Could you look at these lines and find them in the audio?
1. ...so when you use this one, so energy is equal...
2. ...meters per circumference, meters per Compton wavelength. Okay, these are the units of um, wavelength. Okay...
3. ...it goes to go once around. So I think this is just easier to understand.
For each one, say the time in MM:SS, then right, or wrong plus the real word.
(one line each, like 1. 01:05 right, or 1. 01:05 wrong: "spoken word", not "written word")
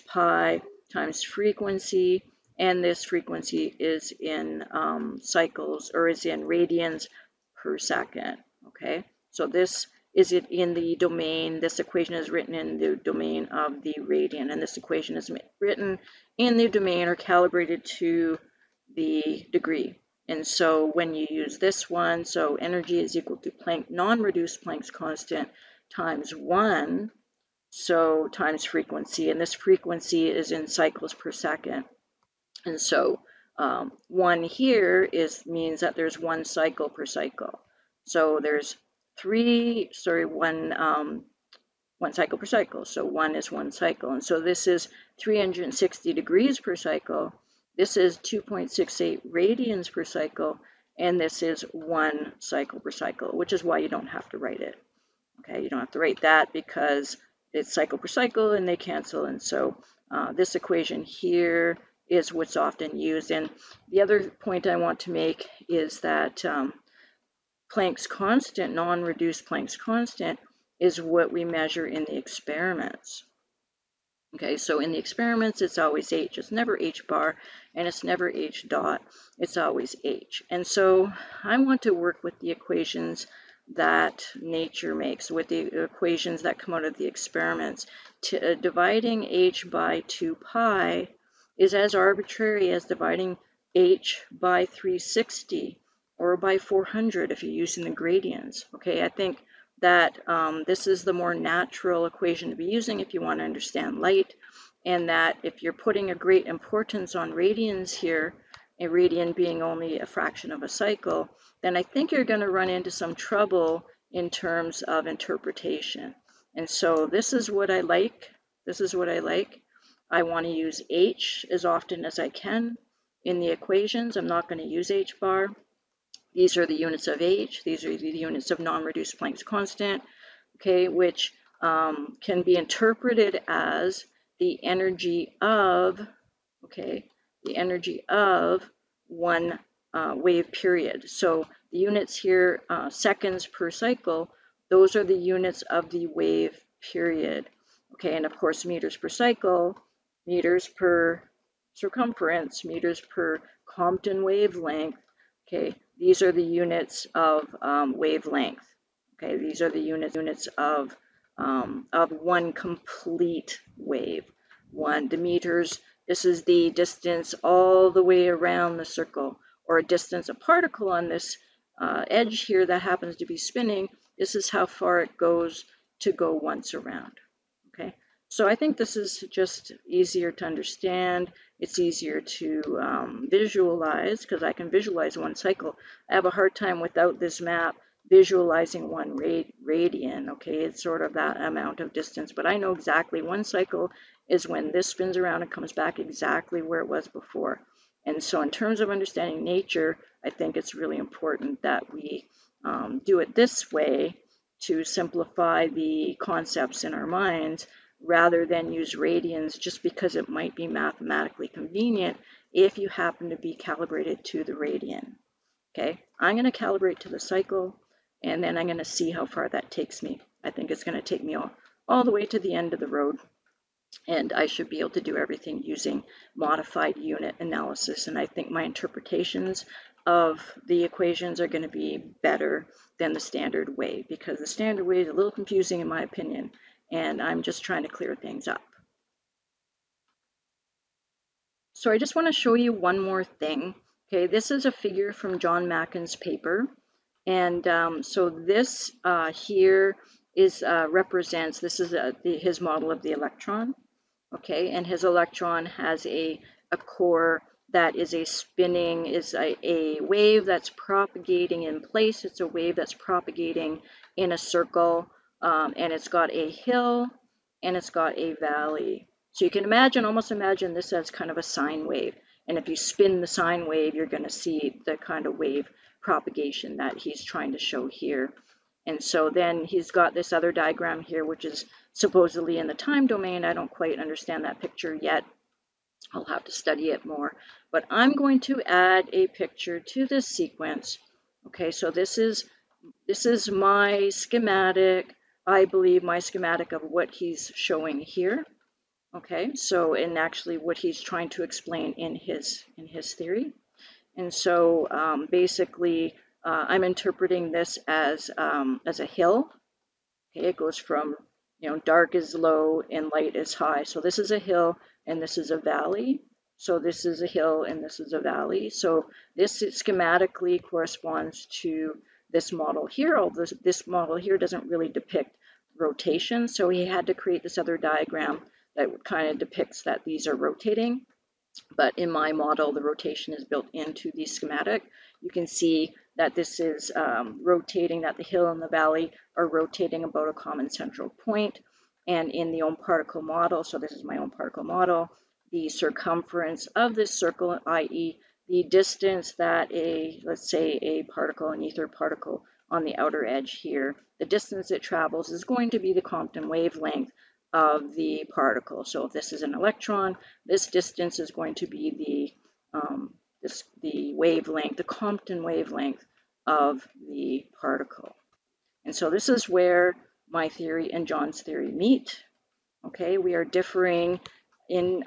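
1. 00:20 right
2. 02:30 right
3. 02:54 right.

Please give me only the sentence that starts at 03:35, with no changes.
Okay, I'm going to calibrate to the cycle and then I'm going to see how far that takes me.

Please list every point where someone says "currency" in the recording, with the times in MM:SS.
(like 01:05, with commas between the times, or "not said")
not said.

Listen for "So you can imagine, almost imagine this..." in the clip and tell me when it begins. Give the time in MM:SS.
04:29.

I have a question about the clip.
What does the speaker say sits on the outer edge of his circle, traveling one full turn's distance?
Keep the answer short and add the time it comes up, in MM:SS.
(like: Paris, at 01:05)
an ether particle, at 05:51.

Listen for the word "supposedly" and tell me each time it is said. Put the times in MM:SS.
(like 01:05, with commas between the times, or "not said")
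04:41.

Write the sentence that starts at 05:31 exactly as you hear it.
But in my model, the rotation is built into the schematic.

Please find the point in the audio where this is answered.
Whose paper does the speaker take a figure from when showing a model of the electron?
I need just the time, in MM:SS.
04:05.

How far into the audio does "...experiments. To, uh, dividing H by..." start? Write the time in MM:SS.
01:27.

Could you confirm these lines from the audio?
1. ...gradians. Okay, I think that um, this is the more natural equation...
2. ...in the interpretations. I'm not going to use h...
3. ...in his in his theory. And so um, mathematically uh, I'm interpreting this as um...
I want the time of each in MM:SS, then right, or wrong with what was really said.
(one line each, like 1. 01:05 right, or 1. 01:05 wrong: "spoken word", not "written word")
1. 01:37 right
2. 02:03 wrong: "equations", not "interpretations"
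3. 05:01 wrong: "basically", not "mathematically".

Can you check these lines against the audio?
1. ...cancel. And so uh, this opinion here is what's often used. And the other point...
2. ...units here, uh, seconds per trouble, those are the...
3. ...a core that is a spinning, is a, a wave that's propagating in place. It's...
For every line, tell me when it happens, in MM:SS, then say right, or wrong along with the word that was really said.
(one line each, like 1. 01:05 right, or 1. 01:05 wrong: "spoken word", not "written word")
1. 00:58 wrong: "equation", not "opinion"
2. 02:21 wrong: "cycle", not "trouble"
3. 04:16 right.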